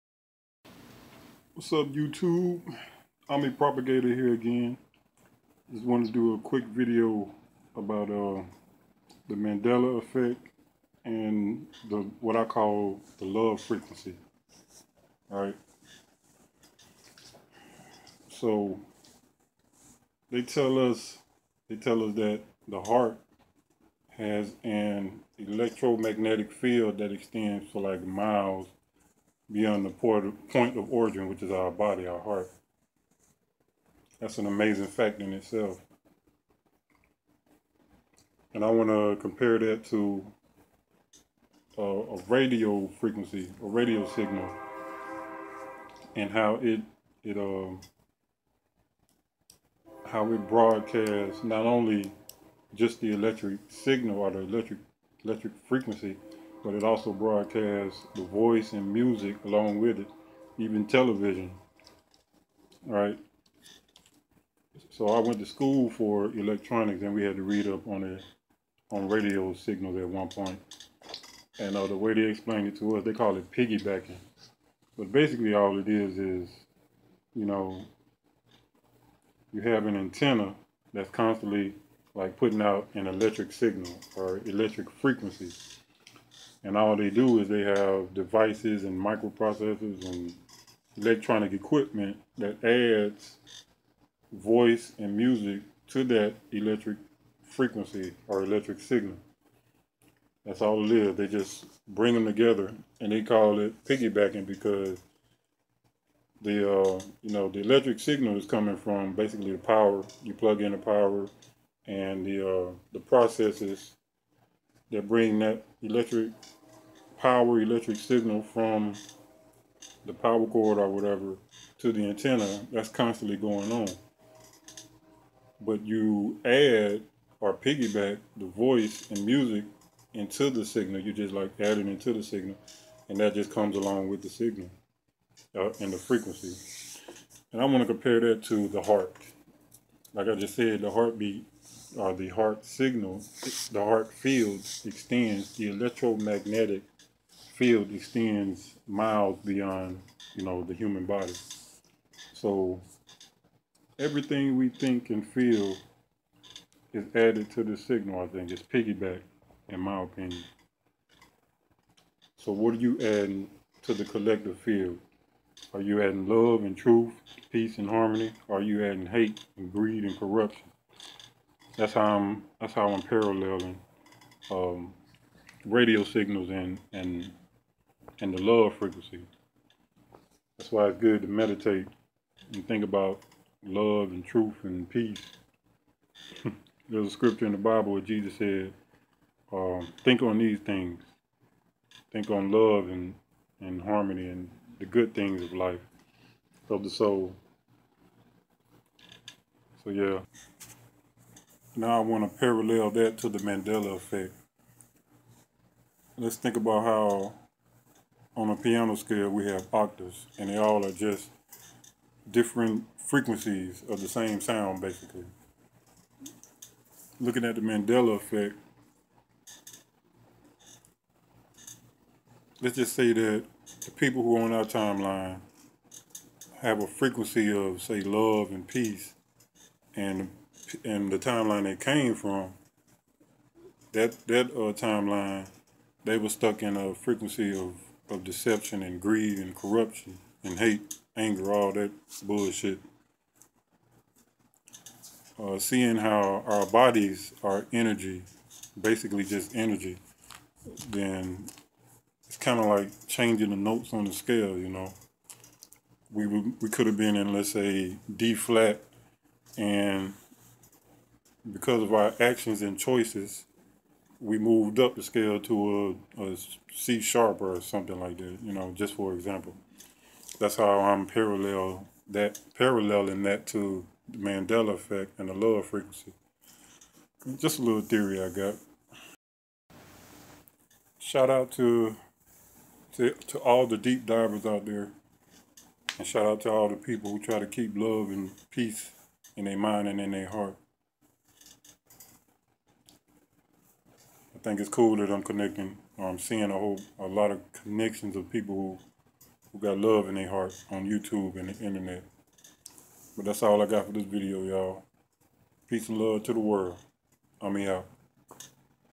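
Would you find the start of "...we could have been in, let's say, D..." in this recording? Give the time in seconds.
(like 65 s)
256 s.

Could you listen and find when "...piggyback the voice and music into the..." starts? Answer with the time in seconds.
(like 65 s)
127 s.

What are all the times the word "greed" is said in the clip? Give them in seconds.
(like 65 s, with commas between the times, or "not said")
169 s, 239 s.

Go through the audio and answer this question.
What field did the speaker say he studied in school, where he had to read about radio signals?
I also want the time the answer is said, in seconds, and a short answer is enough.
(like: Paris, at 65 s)
electronics, at 66 s.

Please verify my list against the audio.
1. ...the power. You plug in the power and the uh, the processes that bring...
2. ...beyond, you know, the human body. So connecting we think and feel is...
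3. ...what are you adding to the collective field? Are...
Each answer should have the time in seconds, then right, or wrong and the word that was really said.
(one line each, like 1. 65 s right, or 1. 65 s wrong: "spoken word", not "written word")
1. 109 s right
2. 149 s wrong: "everything", not "connecting"
3. 162 s right.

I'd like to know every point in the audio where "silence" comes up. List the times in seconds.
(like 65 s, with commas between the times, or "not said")
not said.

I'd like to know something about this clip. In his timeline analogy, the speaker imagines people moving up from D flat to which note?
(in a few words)
C sharp.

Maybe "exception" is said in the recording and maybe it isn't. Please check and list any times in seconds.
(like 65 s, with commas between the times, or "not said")
not said.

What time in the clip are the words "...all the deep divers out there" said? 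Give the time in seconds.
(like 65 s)
283 s.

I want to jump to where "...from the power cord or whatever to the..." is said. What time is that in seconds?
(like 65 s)
118 s.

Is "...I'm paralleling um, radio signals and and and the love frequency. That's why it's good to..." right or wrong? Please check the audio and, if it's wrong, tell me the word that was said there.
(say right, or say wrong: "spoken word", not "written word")
right.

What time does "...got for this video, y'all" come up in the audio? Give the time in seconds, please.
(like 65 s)
303 s.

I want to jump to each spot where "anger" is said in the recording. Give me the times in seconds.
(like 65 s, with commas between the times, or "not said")
241 s.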